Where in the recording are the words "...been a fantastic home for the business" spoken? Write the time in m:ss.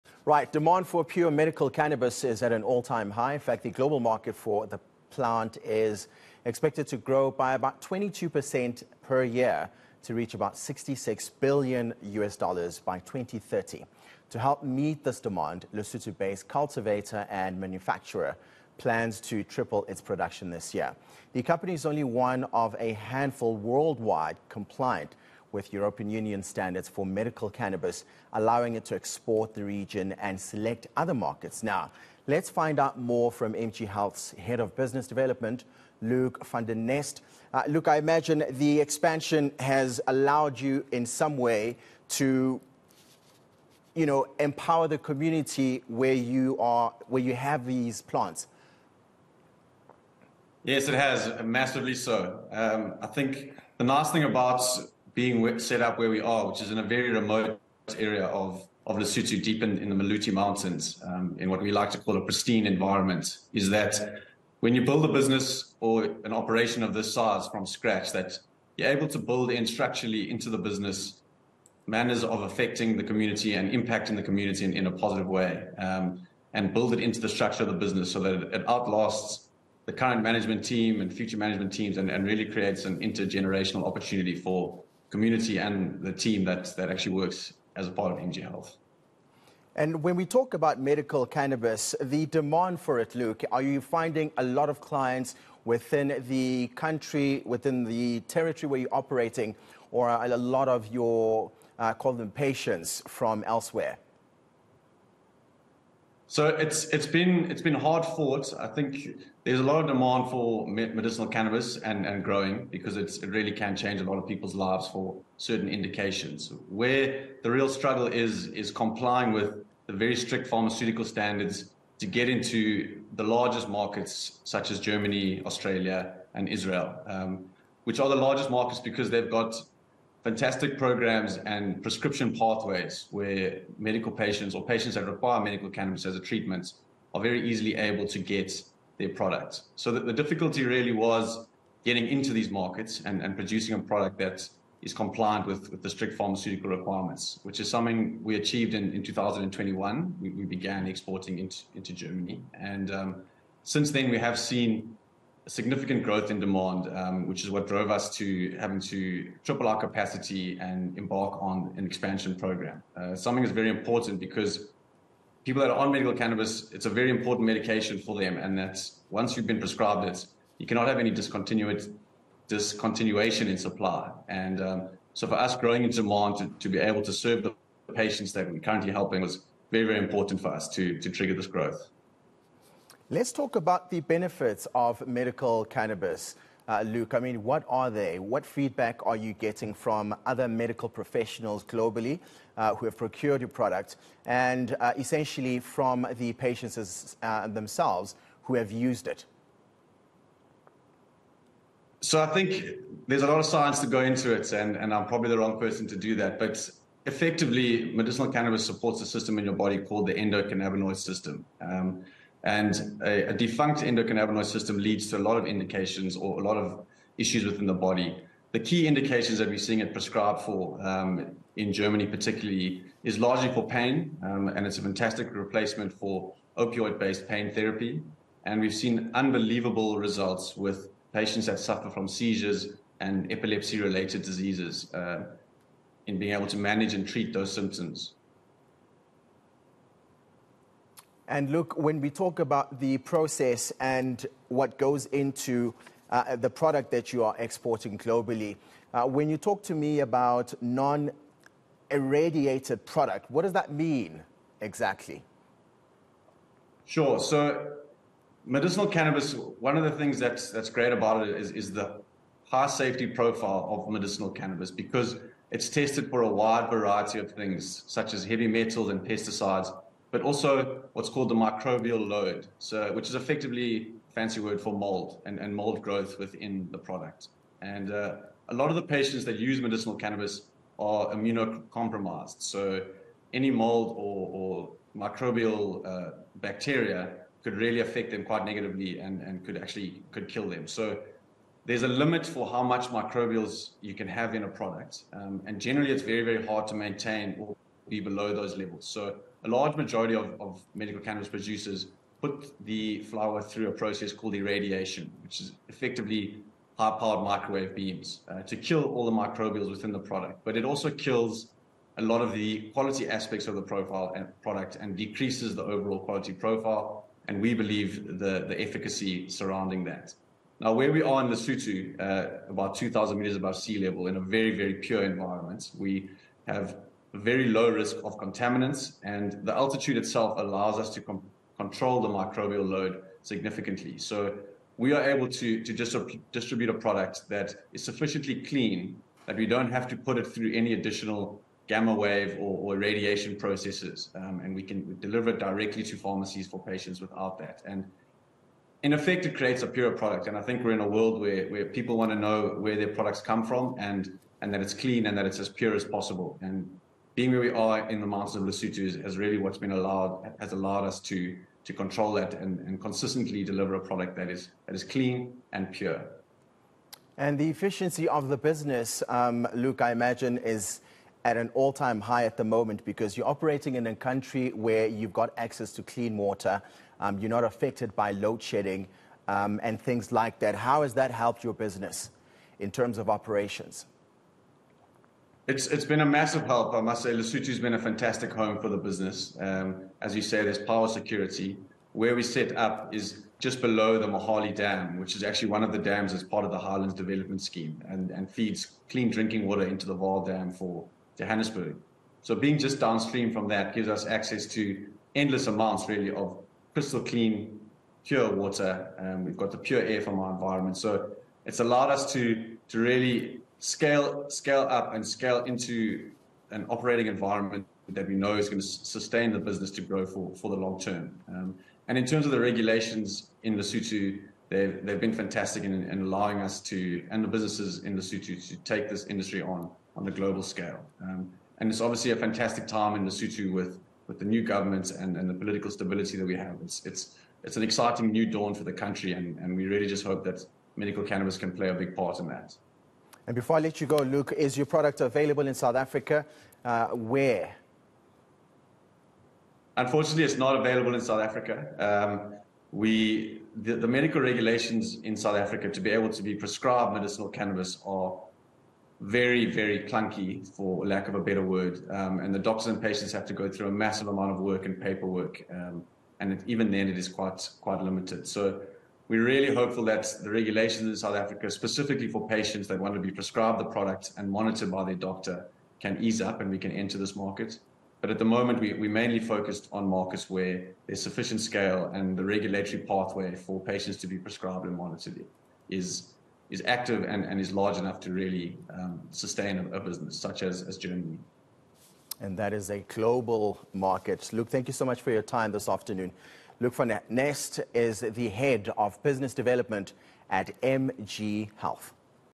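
6:27.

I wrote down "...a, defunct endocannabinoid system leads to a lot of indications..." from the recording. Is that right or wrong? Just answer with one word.
right.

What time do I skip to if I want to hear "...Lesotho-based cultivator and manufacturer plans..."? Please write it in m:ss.
0:15.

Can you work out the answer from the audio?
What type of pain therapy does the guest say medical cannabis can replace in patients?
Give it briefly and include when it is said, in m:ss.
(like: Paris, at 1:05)
opioid based pain therapy, at 3:46.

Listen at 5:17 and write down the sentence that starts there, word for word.
And we believe the, the efficacy surrounding that.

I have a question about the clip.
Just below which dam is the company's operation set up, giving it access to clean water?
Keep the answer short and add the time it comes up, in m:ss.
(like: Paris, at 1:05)
Mohale Dam, at 6:34.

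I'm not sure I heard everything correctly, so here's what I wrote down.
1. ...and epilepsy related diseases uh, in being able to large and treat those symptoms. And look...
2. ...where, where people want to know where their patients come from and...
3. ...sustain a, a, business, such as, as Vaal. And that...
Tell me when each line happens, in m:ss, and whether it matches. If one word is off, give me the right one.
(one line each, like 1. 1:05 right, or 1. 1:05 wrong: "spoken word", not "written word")
1. 3:52 wrong: "manage", not "large"
2. 5:51 wrong: "products", not "patients"
3. 8:09 wrong: "Germany", not "Vaal".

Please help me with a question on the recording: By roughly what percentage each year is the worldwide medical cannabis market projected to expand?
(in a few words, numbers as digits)
22%.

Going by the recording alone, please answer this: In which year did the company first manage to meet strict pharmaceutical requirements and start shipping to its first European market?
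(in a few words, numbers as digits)
2021.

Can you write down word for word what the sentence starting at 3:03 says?
Let's talk about the benefits of medical cannabis.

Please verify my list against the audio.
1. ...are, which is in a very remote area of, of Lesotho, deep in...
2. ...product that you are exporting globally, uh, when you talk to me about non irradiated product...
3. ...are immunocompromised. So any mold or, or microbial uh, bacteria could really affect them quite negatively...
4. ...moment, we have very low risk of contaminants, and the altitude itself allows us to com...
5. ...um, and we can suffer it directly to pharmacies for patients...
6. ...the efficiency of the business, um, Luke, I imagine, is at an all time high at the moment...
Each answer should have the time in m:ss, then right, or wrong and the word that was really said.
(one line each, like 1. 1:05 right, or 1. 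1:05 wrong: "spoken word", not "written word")
1. 0:56 right
2. 4:06 right
3. 4:40 right
4. 5:25 wrong: "environment", not "moment"
5. 5:44 wrong: "deliver", not "suffer"
6. 6:07 right.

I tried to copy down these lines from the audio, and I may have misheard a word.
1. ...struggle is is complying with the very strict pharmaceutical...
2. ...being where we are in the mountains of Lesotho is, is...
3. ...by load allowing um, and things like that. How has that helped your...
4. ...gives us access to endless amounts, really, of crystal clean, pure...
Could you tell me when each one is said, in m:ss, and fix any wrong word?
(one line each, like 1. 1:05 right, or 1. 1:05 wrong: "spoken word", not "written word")
1. 1:57 right
2. 5:57 right
3. 6:17 wrong: "shedding", not "allowing"
4. 6:43 right.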